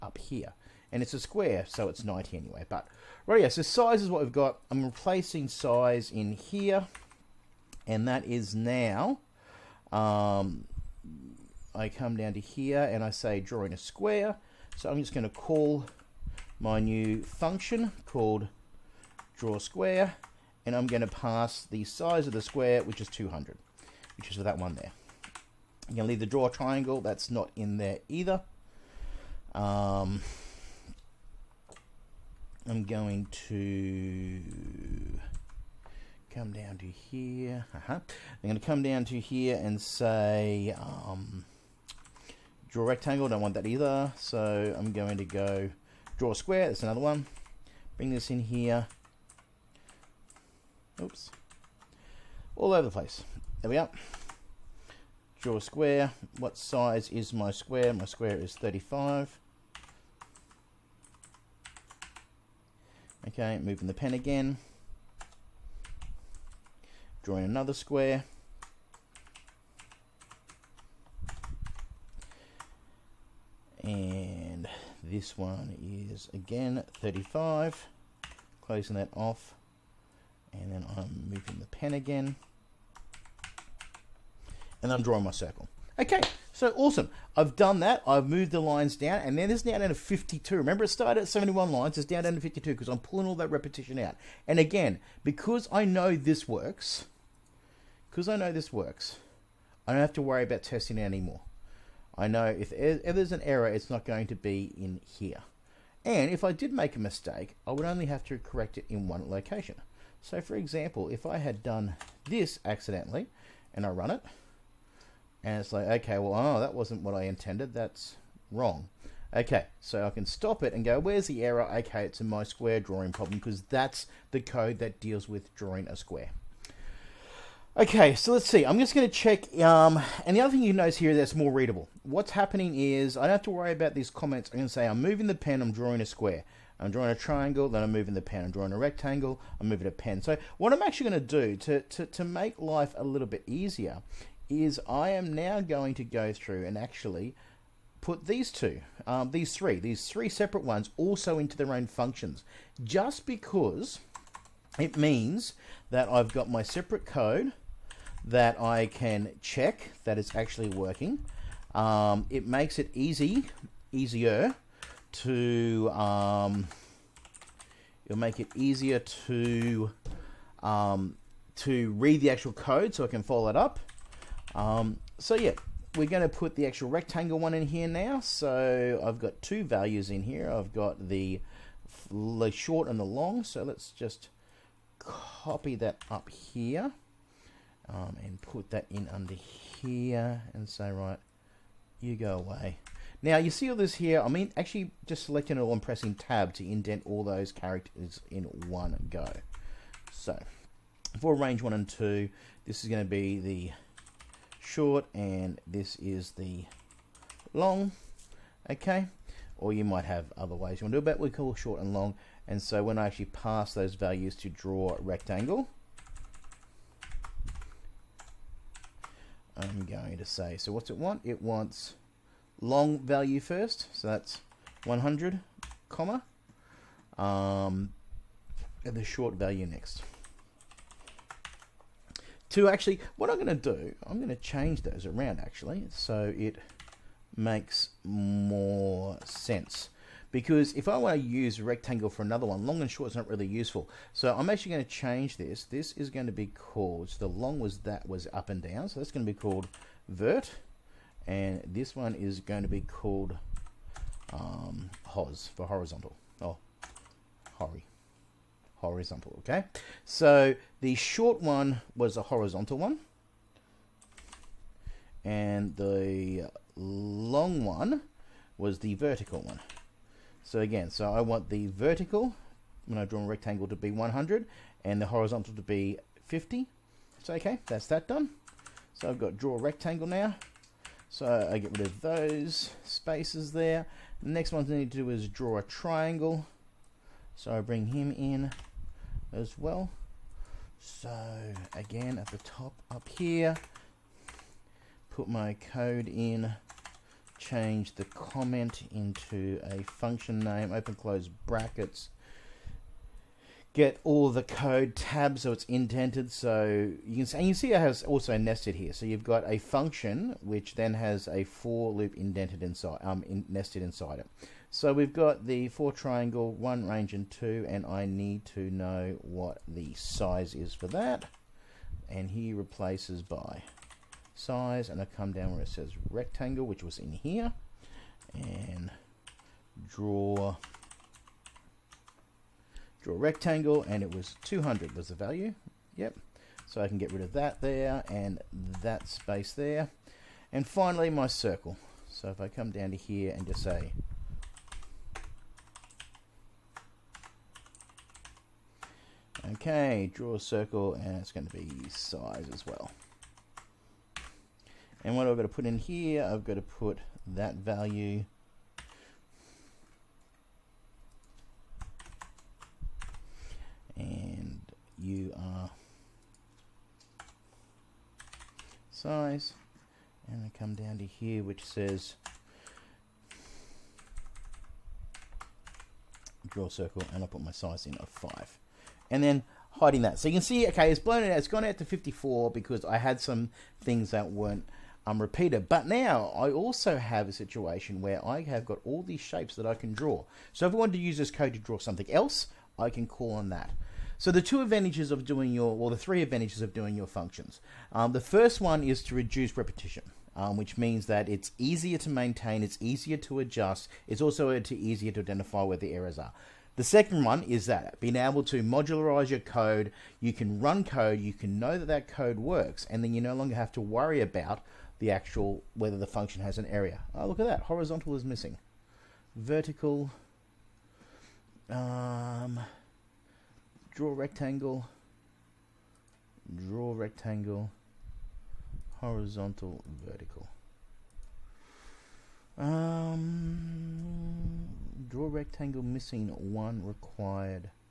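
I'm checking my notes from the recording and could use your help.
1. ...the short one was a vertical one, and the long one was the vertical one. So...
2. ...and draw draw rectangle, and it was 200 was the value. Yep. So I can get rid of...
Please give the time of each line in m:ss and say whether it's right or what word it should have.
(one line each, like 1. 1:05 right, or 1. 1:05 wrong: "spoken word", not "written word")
1. 4:20 wrong: "horizontal", not "vertical"
2. 5:28 right.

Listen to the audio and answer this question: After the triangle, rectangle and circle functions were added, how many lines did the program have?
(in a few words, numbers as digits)
54.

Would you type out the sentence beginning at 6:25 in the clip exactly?
But now I also have a situation where I have got all these shapes that I can draw.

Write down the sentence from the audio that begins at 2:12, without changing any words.
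What's happening is I don't have to worry about these comments.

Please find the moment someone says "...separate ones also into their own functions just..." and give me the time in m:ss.
2:30.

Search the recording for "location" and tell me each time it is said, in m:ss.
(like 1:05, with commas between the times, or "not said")
1:49.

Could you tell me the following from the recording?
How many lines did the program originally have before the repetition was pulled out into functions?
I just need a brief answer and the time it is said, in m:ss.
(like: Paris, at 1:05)
71, at 1:31.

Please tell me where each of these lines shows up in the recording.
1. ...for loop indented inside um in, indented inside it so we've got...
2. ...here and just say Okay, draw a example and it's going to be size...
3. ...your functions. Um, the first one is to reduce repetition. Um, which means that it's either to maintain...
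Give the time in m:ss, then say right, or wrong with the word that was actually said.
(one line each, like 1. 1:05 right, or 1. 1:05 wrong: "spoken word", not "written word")
1. 5:11 wrong: "nested", not "indented"
2. 5:42 wrong: "circle", not "example"
3. 6:36 wrong: "easier", not "either".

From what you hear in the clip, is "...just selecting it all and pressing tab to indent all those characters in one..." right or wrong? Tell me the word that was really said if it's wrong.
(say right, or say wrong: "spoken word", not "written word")
right.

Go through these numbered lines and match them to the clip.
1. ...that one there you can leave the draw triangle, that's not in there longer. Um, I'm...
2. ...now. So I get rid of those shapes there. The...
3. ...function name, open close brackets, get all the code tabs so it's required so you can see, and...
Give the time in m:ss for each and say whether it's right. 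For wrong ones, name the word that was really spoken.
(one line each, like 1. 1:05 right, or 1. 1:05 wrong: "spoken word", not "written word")
1. 0:24 wrong: "either", not "longer"
2. 4:40 wrong: "spaces", not "shapes"
3. 4:59 wrong: "indented", not "required".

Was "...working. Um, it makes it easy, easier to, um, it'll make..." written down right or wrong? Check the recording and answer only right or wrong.
right.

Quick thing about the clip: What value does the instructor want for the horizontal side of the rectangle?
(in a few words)
50.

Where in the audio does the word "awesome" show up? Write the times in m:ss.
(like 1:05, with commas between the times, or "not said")
1:26.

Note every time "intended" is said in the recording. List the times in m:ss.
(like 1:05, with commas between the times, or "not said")
1:57.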